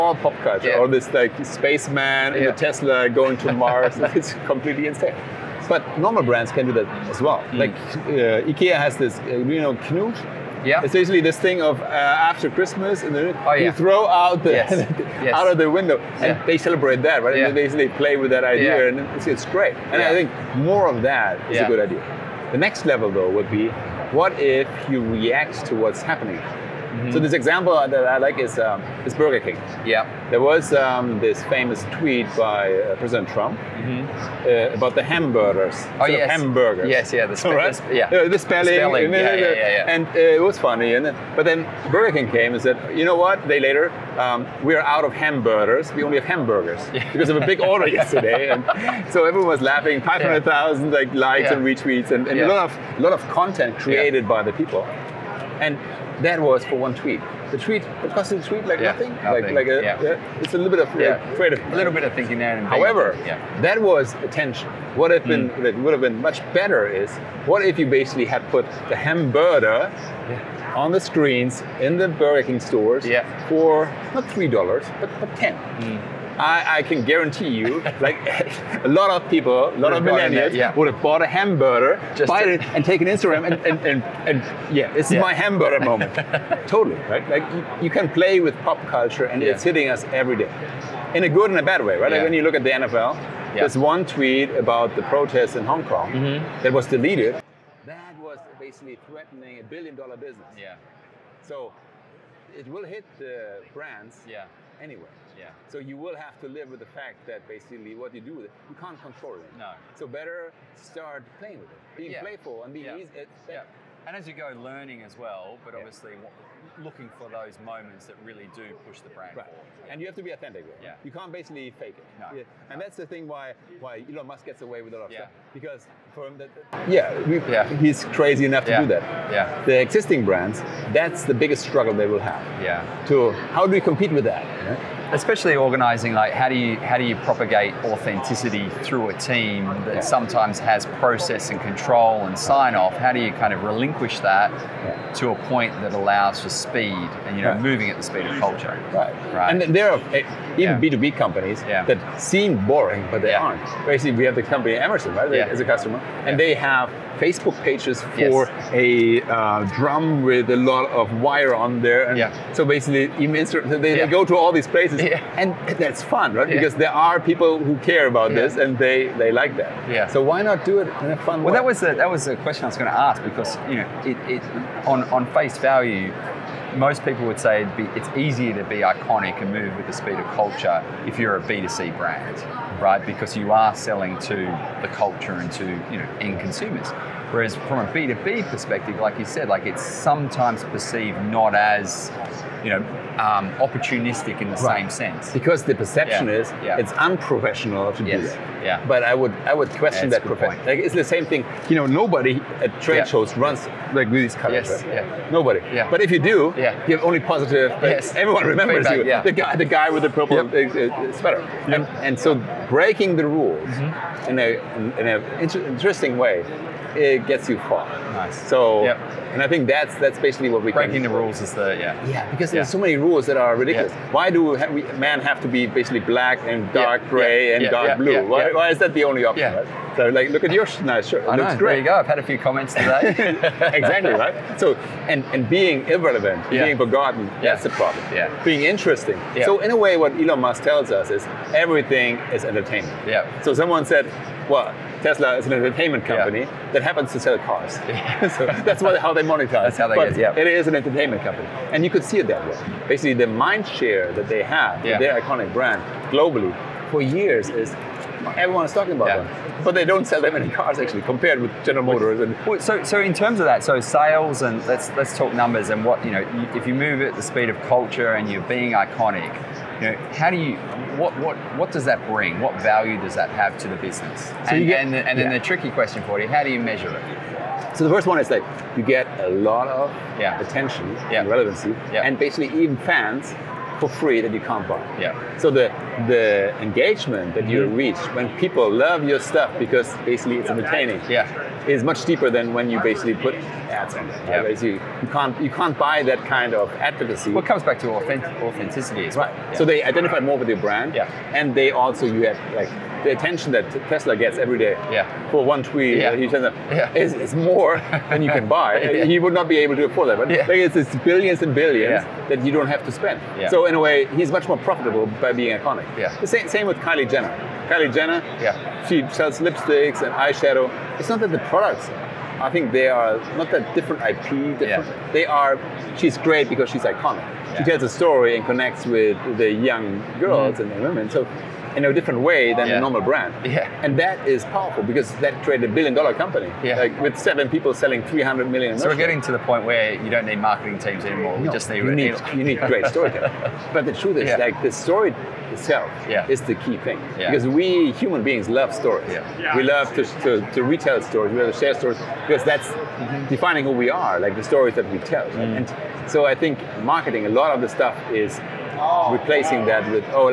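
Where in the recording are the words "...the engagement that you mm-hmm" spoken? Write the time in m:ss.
4:46.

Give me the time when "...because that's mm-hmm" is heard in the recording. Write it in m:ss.
5:52.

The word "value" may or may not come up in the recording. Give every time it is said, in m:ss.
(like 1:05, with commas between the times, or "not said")
2:55, 4:32.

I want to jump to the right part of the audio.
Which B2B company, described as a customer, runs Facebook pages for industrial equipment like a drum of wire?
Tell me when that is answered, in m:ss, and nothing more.
2:34.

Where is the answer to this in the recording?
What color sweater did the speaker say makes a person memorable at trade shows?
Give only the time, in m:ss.
3:30.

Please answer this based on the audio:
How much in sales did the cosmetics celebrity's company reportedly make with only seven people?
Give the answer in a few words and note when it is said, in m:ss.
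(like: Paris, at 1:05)
300 million, at 5:38.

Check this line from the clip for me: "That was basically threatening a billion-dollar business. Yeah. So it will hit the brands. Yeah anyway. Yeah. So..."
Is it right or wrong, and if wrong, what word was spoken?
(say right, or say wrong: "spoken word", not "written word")
right.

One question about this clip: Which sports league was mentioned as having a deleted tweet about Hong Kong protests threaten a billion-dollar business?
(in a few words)
NFL.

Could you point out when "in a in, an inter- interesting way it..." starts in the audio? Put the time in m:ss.
3:34.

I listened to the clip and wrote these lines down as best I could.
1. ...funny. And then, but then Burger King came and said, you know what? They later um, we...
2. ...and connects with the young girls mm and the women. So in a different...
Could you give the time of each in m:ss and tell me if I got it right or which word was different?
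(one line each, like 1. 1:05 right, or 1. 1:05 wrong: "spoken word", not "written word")
1. 0:40 right
2. 5:28 right.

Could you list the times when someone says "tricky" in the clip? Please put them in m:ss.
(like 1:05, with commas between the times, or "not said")
4:35.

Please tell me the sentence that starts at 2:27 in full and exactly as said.
moving at the speed of culture right right and there are eh, even yeah.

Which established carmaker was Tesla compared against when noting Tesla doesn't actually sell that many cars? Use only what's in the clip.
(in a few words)
General Motors.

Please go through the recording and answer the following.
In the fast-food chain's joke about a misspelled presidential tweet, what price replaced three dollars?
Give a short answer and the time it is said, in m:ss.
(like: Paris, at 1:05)
$10, at 1:15.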